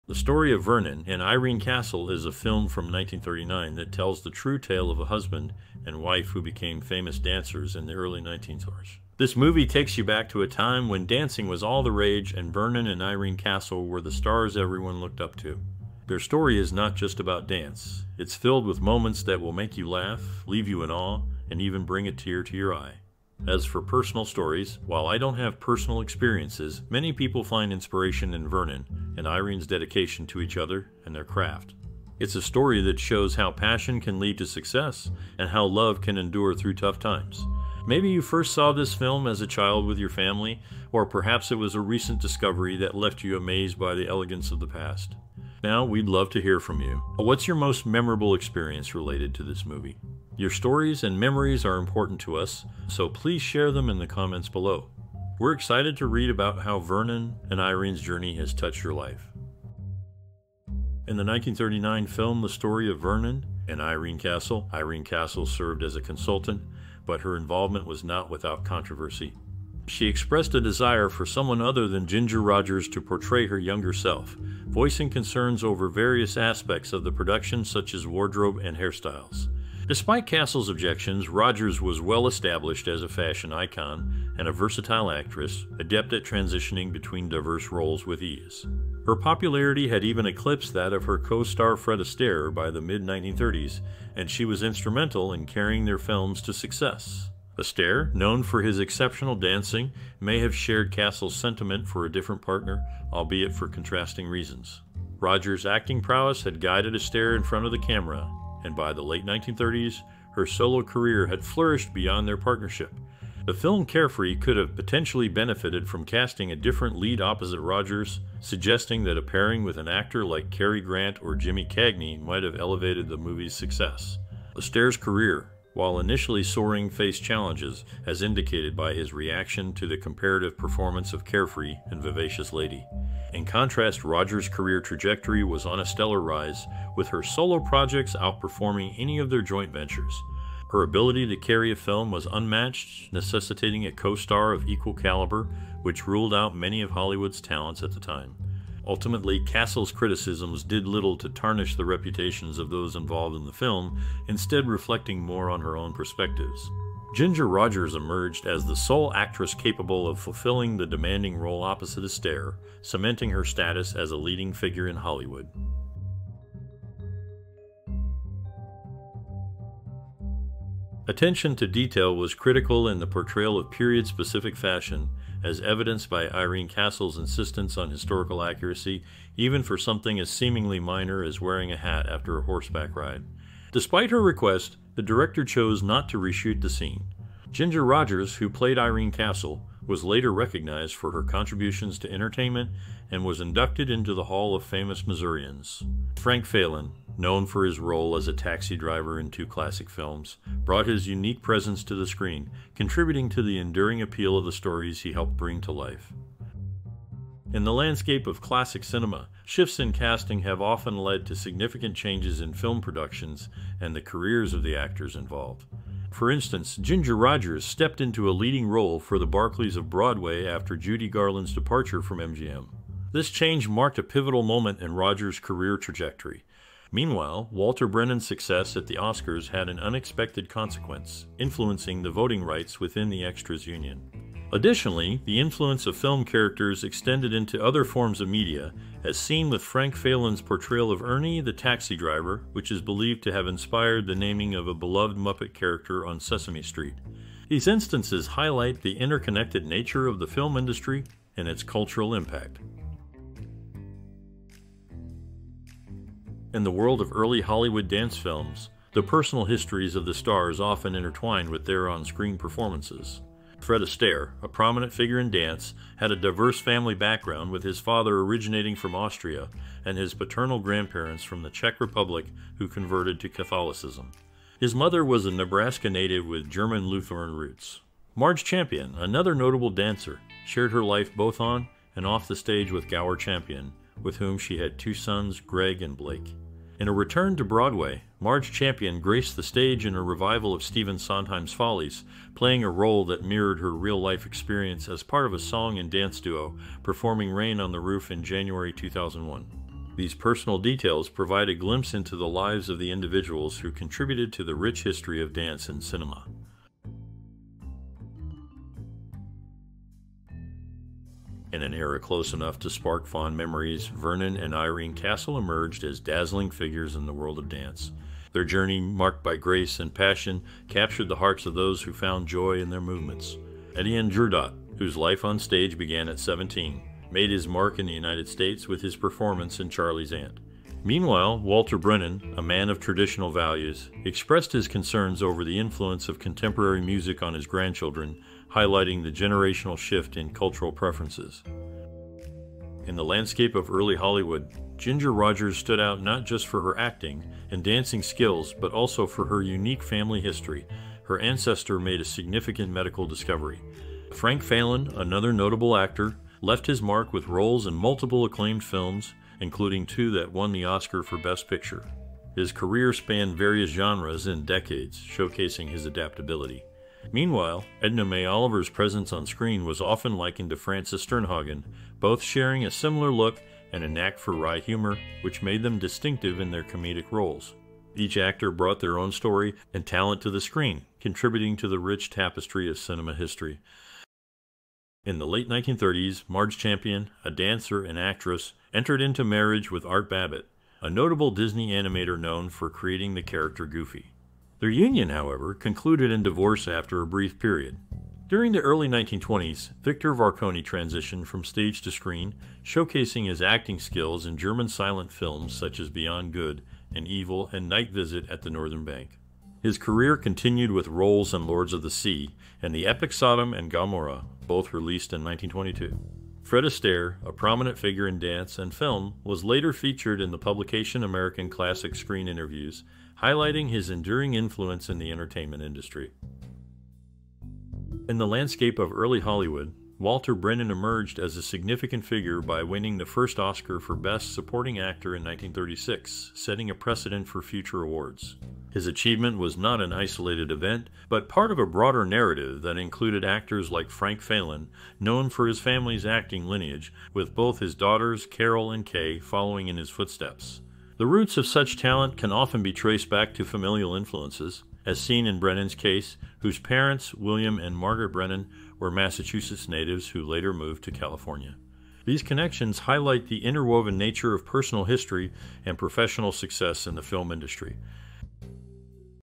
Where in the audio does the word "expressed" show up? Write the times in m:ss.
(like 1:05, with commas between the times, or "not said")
1:10, 5:34.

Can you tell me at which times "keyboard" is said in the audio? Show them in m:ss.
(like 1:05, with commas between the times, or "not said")
not said.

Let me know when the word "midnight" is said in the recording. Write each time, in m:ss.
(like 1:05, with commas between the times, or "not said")
not said.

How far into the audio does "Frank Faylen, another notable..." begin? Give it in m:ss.
5:54.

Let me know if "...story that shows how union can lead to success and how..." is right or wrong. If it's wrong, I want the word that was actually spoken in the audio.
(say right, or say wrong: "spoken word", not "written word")
wrong: "passion", not "union".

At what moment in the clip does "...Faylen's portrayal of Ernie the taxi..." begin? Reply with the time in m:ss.
3:59.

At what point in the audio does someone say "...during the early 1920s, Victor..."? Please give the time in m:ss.
6:38.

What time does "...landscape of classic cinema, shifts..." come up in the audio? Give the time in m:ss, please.
3:27.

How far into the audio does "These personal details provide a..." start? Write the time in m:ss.
4:59.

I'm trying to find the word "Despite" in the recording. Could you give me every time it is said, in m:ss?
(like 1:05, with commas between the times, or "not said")
1:19, 3:03.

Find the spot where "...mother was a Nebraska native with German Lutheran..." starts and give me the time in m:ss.
4:34.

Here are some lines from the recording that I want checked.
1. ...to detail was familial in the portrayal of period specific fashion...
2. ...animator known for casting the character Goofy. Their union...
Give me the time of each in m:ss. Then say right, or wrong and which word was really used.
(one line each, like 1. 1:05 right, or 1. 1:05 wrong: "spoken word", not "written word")
1. 2:51 wrong: "critical", not "familial"
2. 6:31 wrong: "creating", not "casting".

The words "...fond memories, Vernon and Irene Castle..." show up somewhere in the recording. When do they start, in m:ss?
5:13.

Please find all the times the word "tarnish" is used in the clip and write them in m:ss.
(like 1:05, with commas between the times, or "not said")
2:31.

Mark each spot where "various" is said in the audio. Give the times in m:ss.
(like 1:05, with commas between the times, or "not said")
1:15, 6:03.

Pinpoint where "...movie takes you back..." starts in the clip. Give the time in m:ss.
0:09.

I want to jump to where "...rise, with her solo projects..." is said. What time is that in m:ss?
2:16.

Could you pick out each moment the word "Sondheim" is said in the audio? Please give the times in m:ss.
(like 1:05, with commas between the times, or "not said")
4:50.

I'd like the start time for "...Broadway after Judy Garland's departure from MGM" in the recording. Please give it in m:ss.
3:39.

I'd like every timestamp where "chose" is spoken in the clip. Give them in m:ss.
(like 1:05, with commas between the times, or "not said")
3:05.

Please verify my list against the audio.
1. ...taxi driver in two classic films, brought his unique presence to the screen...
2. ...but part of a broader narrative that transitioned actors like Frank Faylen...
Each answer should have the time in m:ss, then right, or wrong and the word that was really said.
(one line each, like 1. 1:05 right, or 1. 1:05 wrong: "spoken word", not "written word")
1. 3:18 right
2. 7:21 wrong: "included", not "transitioned".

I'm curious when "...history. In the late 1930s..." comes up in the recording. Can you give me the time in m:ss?
6:23.